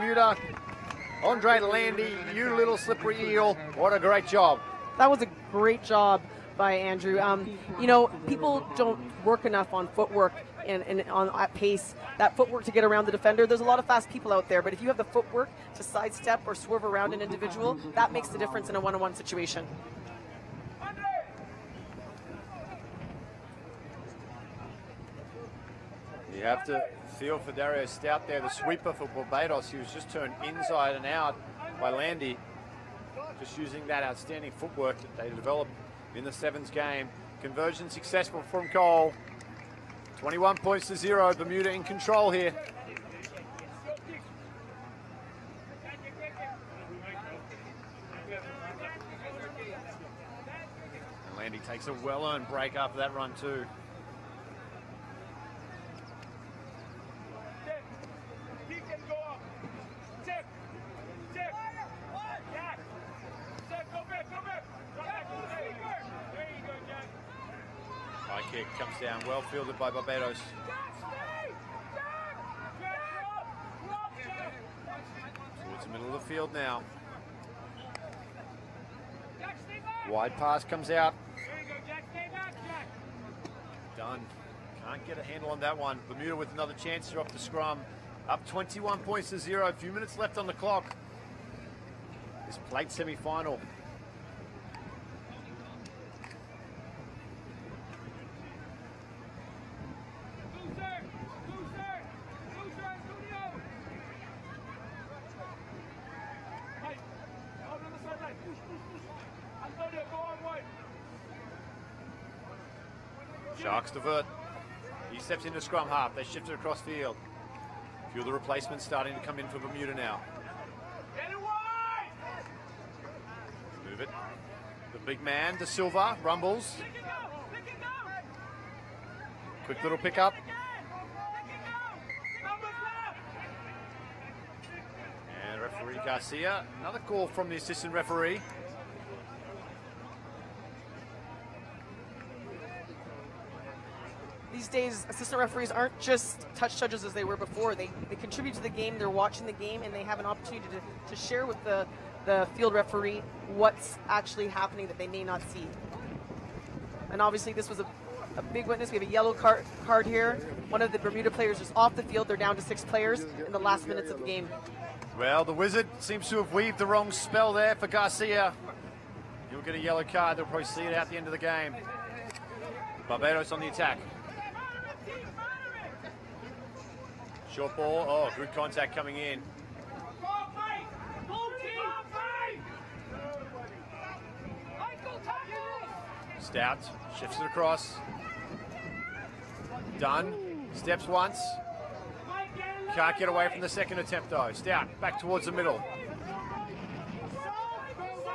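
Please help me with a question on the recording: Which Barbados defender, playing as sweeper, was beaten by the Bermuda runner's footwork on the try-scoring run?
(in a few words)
Dario Stout.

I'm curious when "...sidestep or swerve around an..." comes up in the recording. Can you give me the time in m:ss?
0:15.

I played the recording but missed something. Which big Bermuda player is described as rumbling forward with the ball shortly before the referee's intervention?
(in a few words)
De Silva.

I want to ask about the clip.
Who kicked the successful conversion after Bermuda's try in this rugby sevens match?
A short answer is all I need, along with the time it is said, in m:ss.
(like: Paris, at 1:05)
Cole, at 0:38.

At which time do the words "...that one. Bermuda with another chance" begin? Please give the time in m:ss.
1:25.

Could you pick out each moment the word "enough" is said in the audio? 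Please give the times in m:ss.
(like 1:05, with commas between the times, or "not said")
0:09.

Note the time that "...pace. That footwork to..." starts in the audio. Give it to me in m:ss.
0:11.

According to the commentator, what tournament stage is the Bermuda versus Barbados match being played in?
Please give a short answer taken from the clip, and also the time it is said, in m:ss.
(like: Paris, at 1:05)
Plate semi-final, at 1:32.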